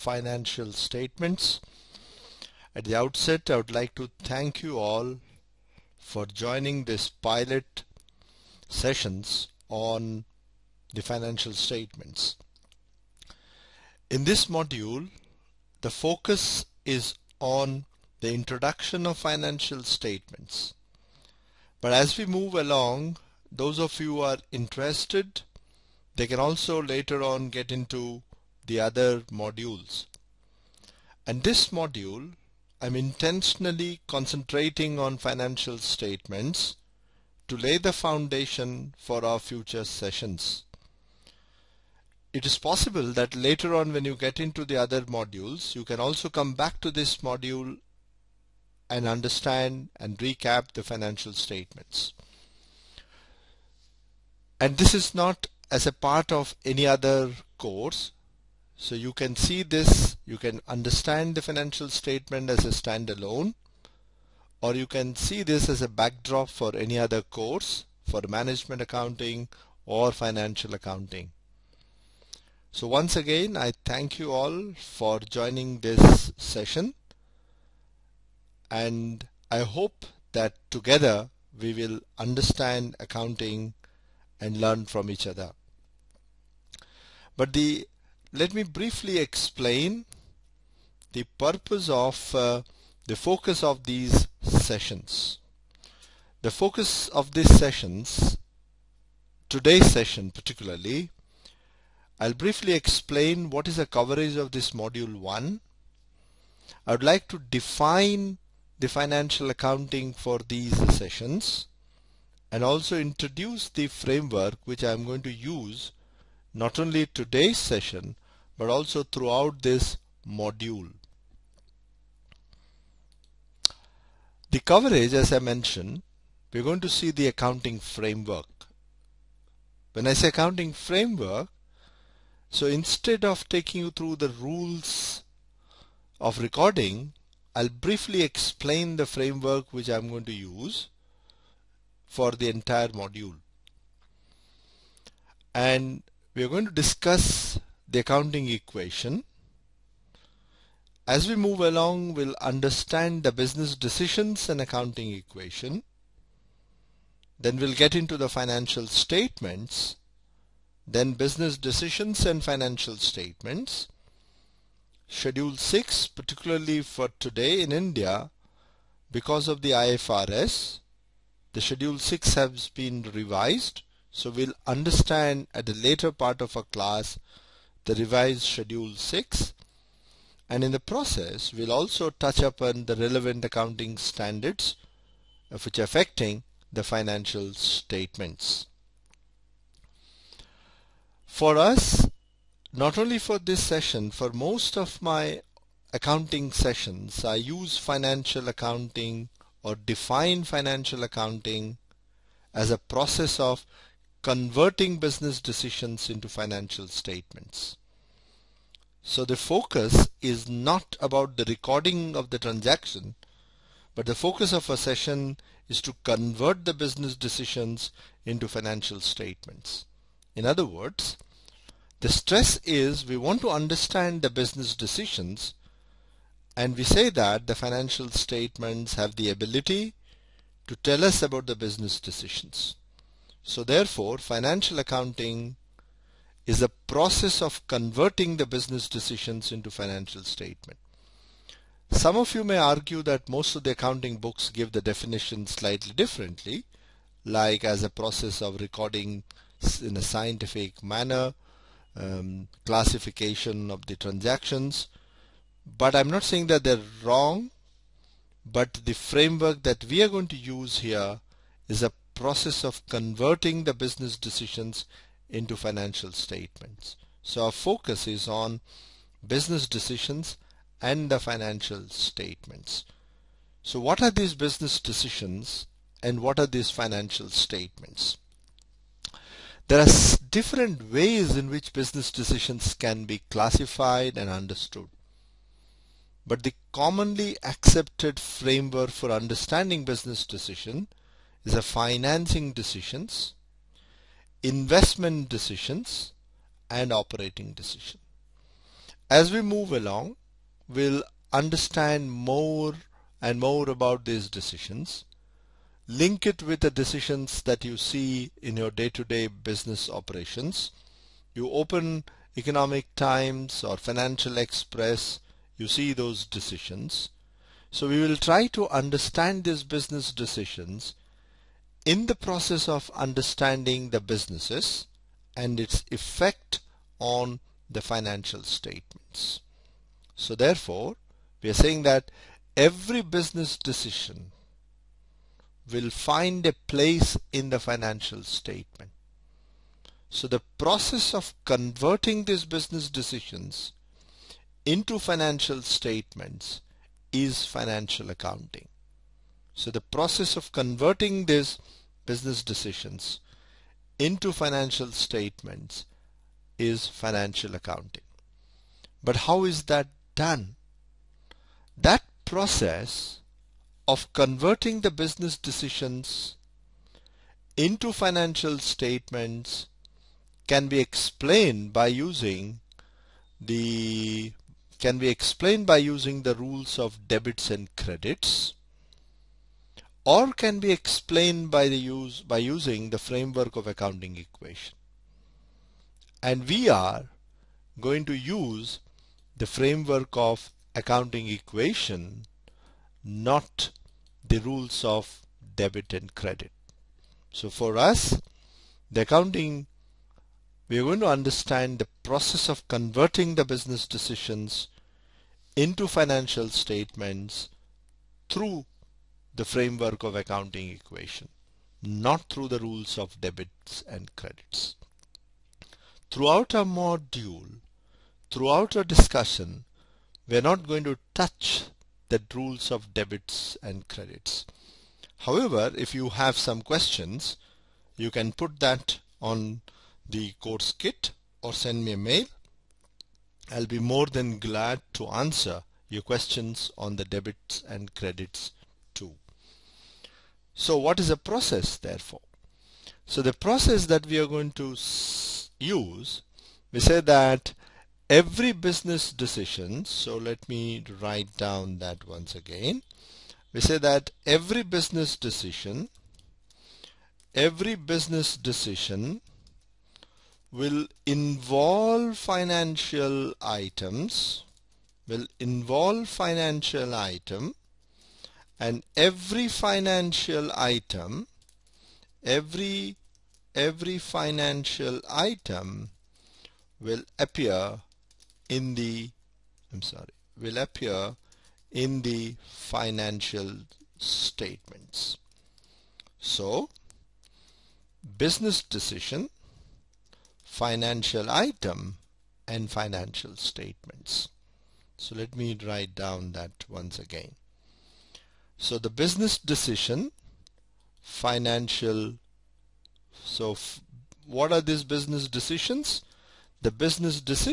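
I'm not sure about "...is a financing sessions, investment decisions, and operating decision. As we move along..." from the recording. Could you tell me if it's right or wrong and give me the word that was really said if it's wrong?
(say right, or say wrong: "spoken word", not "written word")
wrong: "decisions", not "sessions".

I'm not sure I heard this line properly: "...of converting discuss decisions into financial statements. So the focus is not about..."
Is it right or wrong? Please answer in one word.
wrong.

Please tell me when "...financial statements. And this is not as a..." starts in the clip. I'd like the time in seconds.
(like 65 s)
50 s.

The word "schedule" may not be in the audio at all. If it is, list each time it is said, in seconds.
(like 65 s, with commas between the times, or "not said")
165 s, 171 s, 178 s.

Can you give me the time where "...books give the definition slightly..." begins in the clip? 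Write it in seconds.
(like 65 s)
244 s.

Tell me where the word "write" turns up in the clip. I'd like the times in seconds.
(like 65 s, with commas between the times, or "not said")
451 s, 495 s.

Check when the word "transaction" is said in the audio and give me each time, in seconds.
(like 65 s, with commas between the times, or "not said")
212 s, 253 s.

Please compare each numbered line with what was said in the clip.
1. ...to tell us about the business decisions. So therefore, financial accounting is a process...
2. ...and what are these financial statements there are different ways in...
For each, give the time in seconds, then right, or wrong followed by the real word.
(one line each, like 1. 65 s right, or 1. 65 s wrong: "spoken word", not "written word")
1. 230 s right
2. 276 s right.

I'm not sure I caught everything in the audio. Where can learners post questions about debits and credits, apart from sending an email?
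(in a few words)
Course kit.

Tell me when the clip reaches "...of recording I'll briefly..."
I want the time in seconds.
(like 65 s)
136 s.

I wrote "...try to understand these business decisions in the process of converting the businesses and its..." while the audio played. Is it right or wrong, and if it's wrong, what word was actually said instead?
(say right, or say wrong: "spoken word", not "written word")
wrong: "understanding", not "converting".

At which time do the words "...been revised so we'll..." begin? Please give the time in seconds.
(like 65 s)
172 s.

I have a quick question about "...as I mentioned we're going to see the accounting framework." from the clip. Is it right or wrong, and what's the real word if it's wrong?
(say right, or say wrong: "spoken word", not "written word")
right.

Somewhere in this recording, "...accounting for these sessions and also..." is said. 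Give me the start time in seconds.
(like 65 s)
109 s.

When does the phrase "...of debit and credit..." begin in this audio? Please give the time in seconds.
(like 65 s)
394 s.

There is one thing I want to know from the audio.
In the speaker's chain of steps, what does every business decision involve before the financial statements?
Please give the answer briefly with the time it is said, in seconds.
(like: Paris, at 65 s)
Financial items, at 462 s.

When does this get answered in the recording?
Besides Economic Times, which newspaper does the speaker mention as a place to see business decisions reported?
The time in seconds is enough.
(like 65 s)
313 s.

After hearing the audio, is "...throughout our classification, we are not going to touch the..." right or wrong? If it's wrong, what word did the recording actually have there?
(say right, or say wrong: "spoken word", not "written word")
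wrong: "discussion", not "classification".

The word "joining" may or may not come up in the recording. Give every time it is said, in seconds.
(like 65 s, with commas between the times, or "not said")
6 s, 75 s.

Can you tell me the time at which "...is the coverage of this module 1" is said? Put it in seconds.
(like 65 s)
103 s.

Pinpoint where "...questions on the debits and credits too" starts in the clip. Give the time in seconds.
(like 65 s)
436 s.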